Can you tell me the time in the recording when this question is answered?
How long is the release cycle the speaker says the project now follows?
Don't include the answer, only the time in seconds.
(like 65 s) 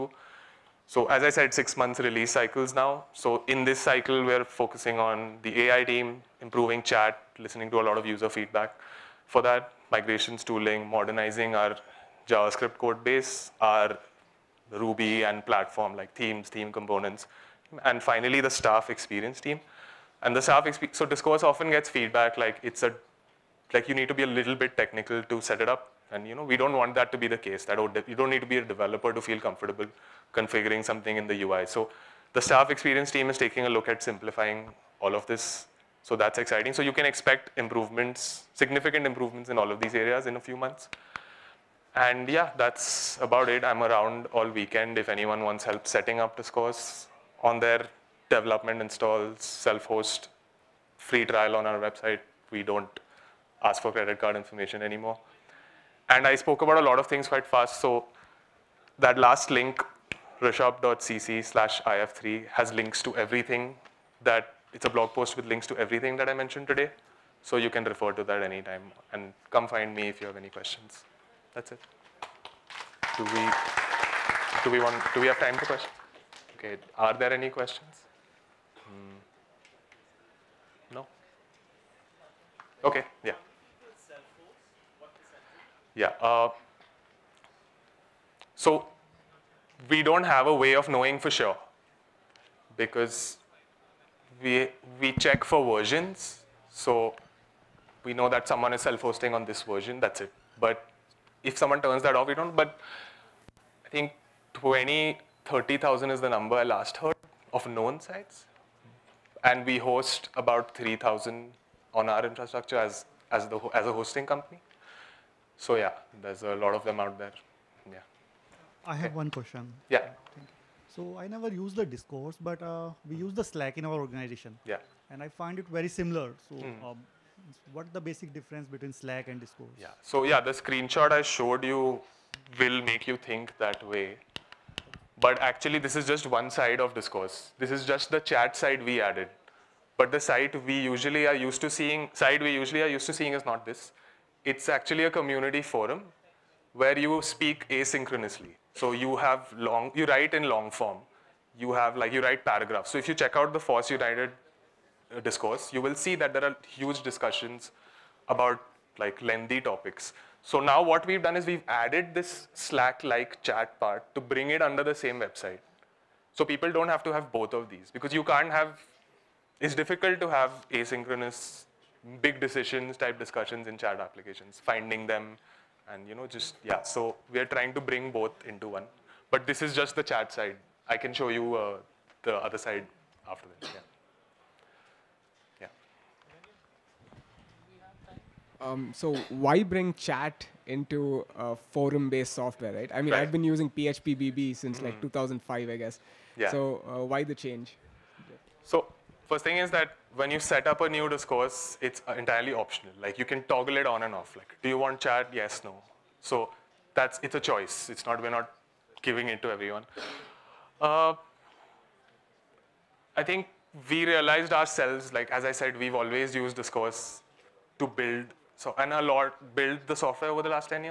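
1 s.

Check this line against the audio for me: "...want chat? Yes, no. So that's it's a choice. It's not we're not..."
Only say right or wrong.
right.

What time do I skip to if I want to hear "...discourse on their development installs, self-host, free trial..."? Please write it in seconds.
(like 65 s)
46 s.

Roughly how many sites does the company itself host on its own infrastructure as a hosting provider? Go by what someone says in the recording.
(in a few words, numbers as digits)
3,000.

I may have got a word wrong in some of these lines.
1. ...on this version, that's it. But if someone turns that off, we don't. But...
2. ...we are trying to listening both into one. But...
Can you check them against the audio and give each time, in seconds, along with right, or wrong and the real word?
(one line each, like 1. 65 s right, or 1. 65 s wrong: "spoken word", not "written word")
1. 99 s right
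2. 177 s wrong: "bring", not "listening".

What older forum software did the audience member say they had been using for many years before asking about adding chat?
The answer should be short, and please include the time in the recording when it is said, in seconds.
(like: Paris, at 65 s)
phpBB, at 193 s.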